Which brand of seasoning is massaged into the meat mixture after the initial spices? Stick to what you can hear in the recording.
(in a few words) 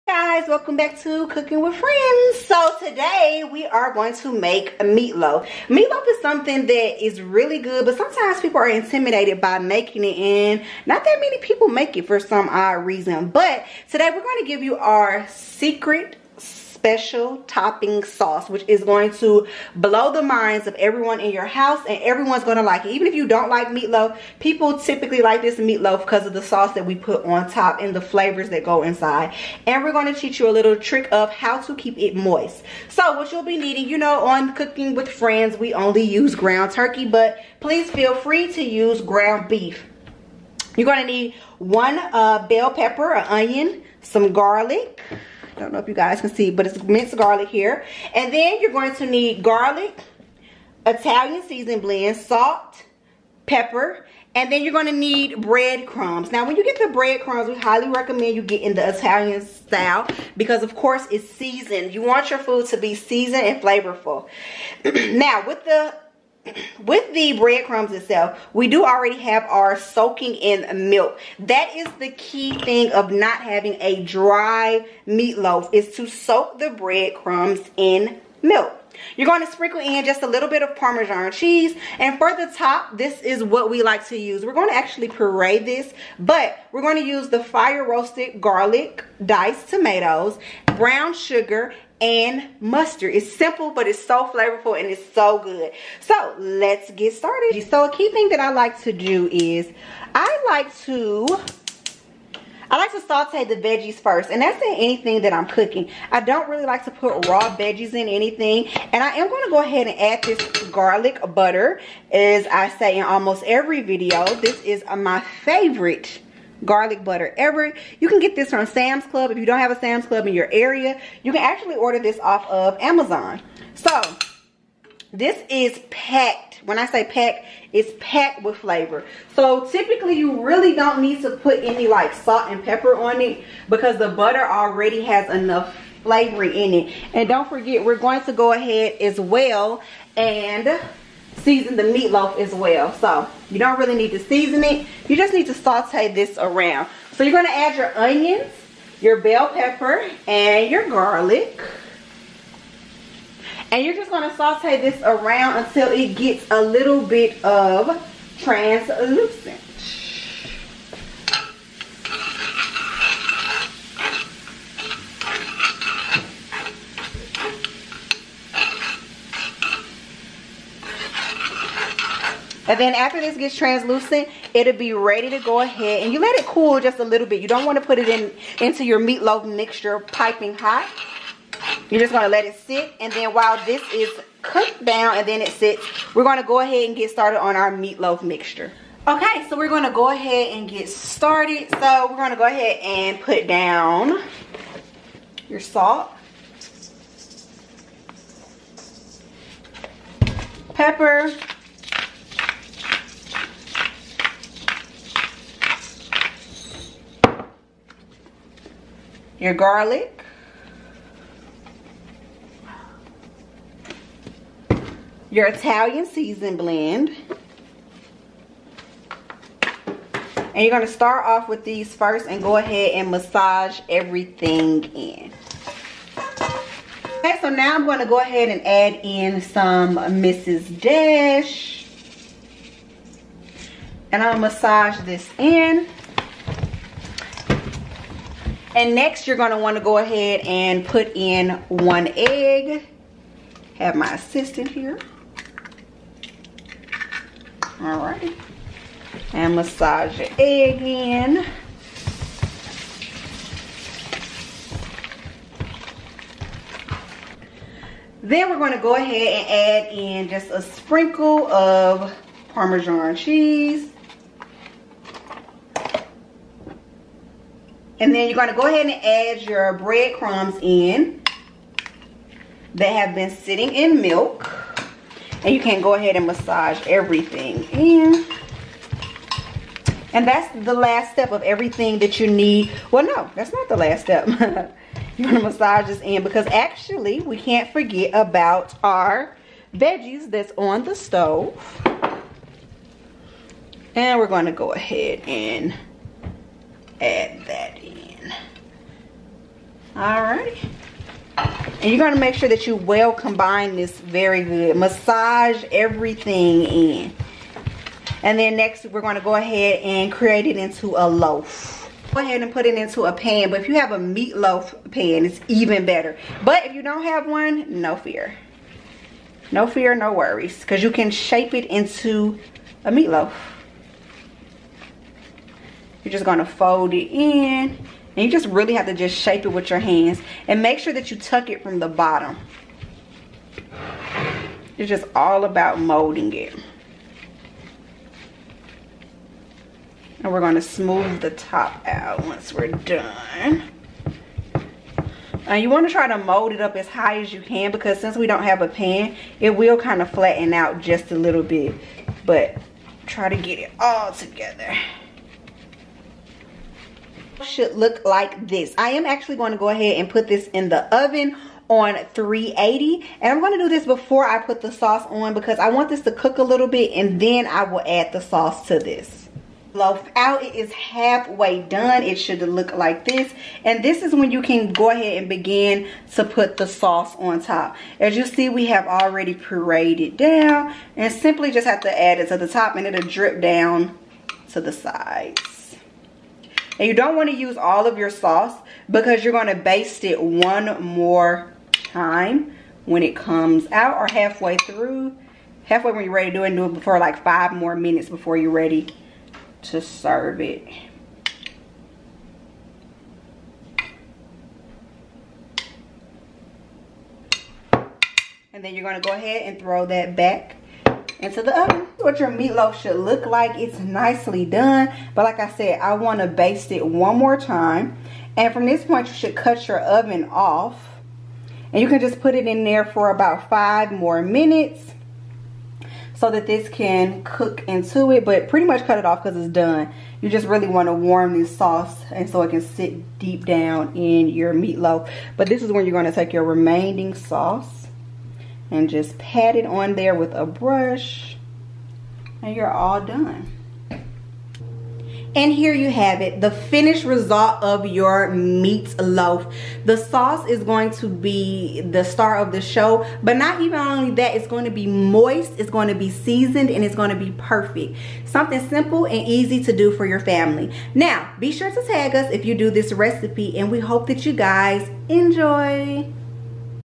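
Mrs. Dash.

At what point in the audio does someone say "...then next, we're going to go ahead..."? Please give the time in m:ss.
5:08.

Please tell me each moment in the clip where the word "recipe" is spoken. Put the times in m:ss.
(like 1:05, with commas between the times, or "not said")
7:42.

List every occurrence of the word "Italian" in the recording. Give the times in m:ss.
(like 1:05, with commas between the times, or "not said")
0:50, 0:58, 3:35.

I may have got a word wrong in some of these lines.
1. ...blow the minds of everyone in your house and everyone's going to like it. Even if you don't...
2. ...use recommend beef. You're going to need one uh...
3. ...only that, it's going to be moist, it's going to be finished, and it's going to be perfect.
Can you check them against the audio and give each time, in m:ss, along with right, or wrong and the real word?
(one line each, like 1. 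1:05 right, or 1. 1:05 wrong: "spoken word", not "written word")
1. 0:19 right
2. 0:38 wrong: "ground", not "recommend"
3. 7:33 wrong: "seasoned", not "finished".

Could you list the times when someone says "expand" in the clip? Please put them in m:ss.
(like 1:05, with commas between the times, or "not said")
not said.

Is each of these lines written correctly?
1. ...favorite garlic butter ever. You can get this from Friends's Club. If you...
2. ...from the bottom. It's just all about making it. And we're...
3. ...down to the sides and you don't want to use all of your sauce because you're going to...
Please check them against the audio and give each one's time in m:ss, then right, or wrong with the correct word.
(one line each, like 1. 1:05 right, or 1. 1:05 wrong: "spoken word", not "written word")
1. 1:55 wrong: "Sam", not "Friends"
2. 5:31 wrong: "molding", not "making"
3. 6:23 right.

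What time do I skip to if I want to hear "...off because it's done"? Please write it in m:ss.
7:09.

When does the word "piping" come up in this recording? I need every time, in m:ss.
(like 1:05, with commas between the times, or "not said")
2:59.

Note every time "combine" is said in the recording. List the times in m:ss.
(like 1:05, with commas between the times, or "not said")
5:03.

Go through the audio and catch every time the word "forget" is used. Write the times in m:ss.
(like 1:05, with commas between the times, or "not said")
2:17, 4:47.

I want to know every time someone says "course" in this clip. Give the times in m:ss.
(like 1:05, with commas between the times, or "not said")
1:00.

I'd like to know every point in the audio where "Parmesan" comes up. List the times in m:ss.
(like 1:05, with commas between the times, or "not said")
1:20, 4:22.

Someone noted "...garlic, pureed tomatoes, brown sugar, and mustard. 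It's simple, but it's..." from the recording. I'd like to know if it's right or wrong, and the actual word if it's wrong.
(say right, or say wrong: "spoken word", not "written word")
wrong: "diced", not "pureed".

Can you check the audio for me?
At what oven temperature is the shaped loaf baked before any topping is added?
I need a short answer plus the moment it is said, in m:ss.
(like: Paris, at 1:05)
380, at 6:02.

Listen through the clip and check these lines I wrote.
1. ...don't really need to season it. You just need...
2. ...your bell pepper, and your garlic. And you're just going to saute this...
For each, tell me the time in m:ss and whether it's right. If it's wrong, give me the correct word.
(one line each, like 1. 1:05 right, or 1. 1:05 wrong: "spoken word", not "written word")
1. 2:23 right
2. 2:28 right.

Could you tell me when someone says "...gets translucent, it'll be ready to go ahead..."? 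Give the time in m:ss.
2:53.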